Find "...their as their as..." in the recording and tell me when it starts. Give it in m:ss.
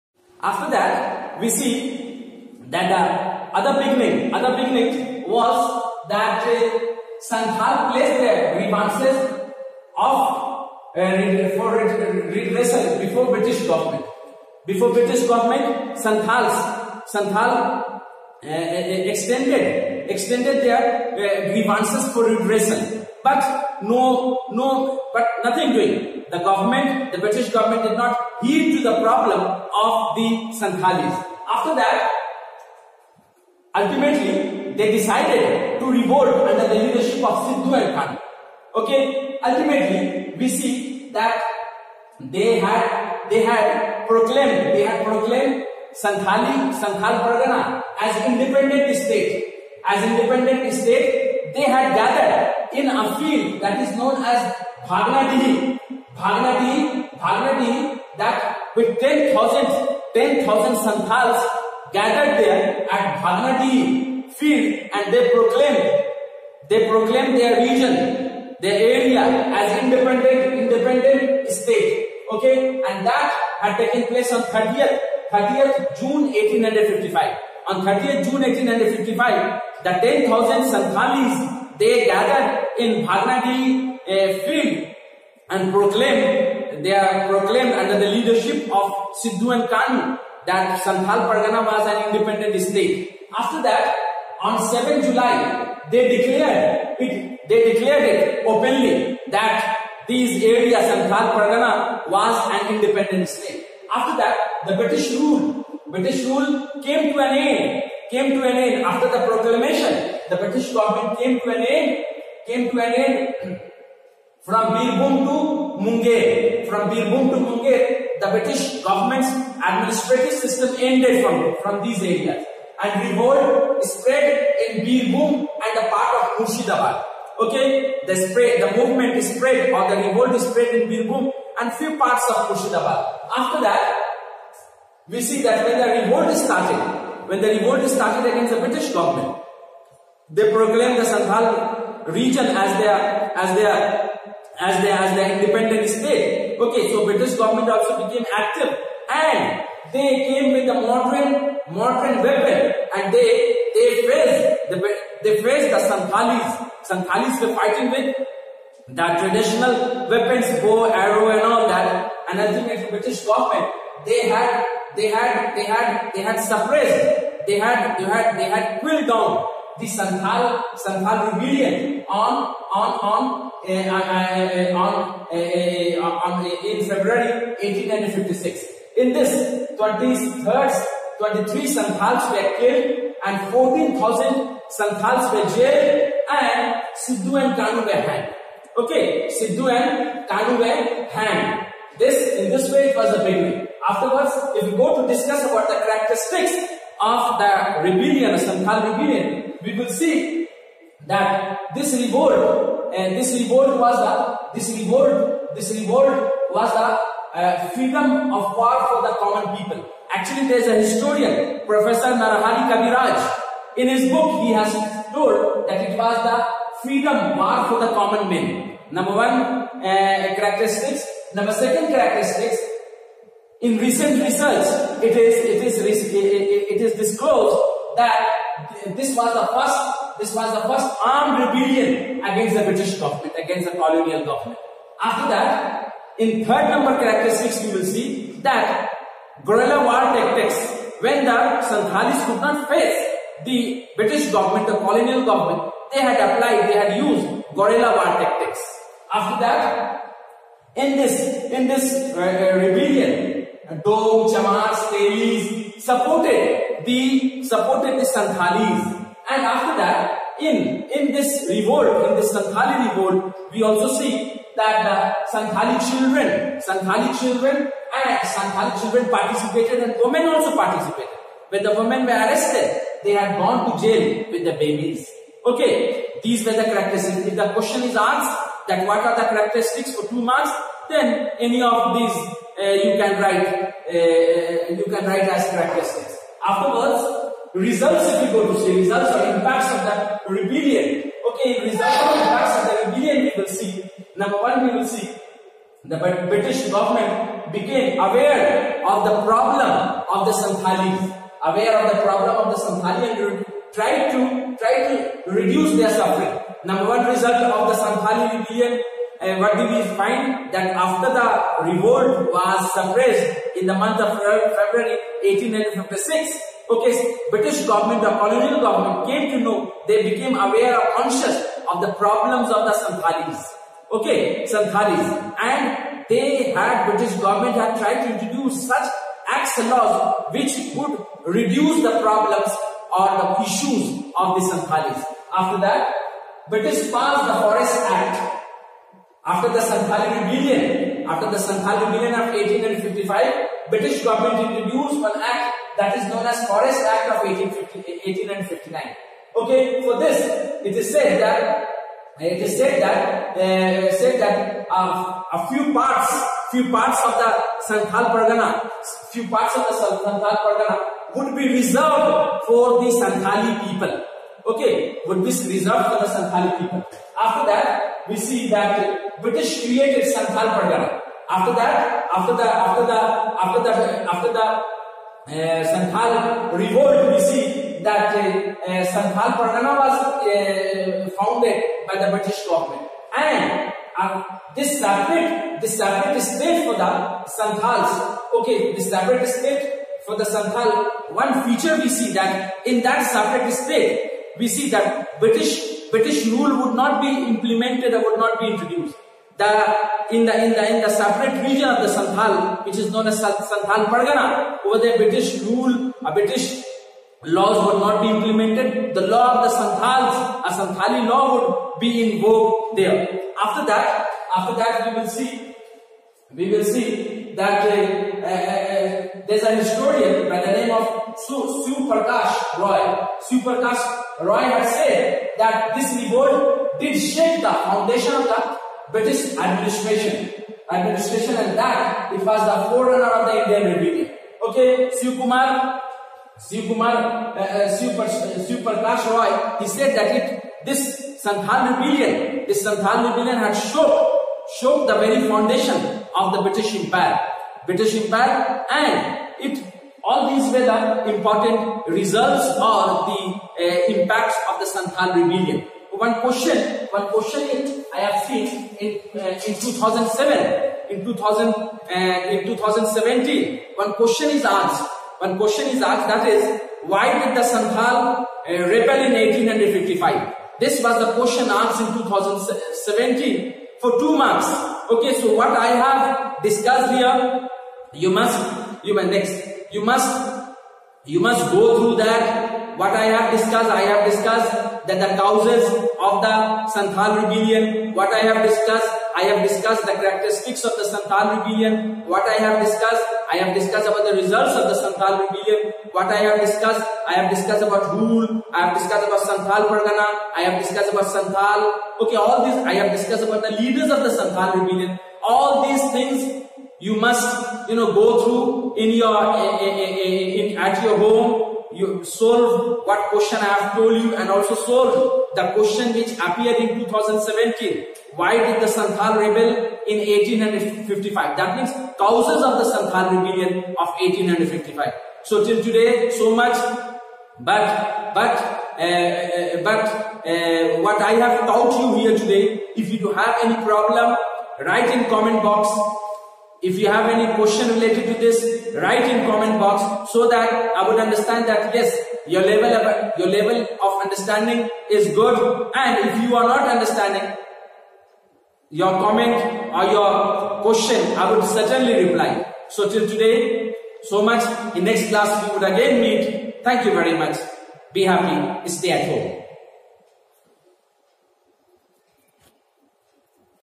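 2:22.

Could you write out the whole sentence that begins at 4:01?
When the Santhalis could not face the British government, the colonial government, they had applied, they had used guerrilla war tactics.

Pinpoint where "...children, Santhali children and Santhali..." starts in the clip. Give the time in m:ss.
4:25.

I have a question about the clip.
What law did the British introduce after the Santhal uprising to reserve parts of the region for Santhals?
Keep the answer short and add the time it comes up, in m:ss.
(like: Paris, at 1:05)
Forest Act of 1859, at 5:46.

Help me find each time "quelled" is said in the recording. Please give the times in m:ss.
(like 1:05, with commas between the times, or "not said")
2:48.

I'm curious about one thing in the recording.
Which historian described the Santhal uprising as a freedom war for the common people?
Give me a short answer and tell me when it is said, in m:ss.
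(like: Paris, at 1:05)
Narahari Kaviraj, at 3:32.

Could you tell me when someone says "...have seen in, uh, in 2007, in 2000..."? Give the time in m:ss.
7:37.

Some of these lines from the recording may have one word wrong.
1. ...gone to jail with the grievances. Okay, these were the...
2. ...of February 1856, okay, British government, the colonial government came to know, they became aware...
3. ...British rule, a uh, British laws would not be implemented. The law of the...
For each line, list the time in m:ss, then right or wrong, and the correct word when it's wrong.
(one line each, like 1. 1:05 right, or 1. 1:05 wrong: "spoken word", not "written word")
1. 4:33 wrong: "babies", not "grievances"
2. 5:14 right
3. 6:44 right.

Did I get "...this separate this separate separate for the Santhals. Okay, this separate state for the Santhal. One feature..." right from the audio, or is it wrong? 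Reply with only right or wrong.
wrong.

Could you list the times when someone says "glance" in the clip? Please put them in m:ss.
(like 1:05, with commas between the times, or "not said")
not said.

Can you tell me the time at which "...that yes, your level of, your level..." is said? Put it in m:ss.
9:01.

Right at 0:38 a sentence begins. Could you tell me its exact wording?
Okay, ultimately, we see that they had they had proclaimed they had proclaimed Santhali Santhal Pargana as independent state.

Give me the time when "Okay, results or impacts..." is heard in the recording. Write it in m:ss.
4:51.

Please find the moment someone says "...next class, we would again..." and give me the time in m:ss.
9:14.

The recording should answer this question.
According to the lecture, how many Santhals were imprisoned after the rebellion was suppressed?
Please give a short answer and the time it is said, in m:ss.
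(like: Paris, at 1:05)
14,000, at 3:03.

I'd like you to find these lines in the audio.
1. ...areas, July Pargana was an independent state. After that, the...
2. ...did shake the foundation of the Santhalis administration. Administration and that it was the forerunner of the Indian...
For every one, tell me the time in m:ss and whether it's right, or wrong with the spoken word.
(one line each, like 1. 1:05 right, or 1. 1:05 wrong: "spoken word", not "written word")
1. 1:40 wrong: "Santhal", not "July"
2. 7:06 wrong: "British", not "Santhalis".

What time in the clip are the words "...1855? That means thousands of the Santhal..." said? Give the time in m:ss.
8:39.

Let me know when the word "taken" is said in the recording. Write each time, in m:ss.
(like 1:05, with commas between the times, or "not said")
1:13.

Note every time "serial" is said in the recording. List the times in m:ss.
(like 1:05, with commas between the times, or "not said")
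not said.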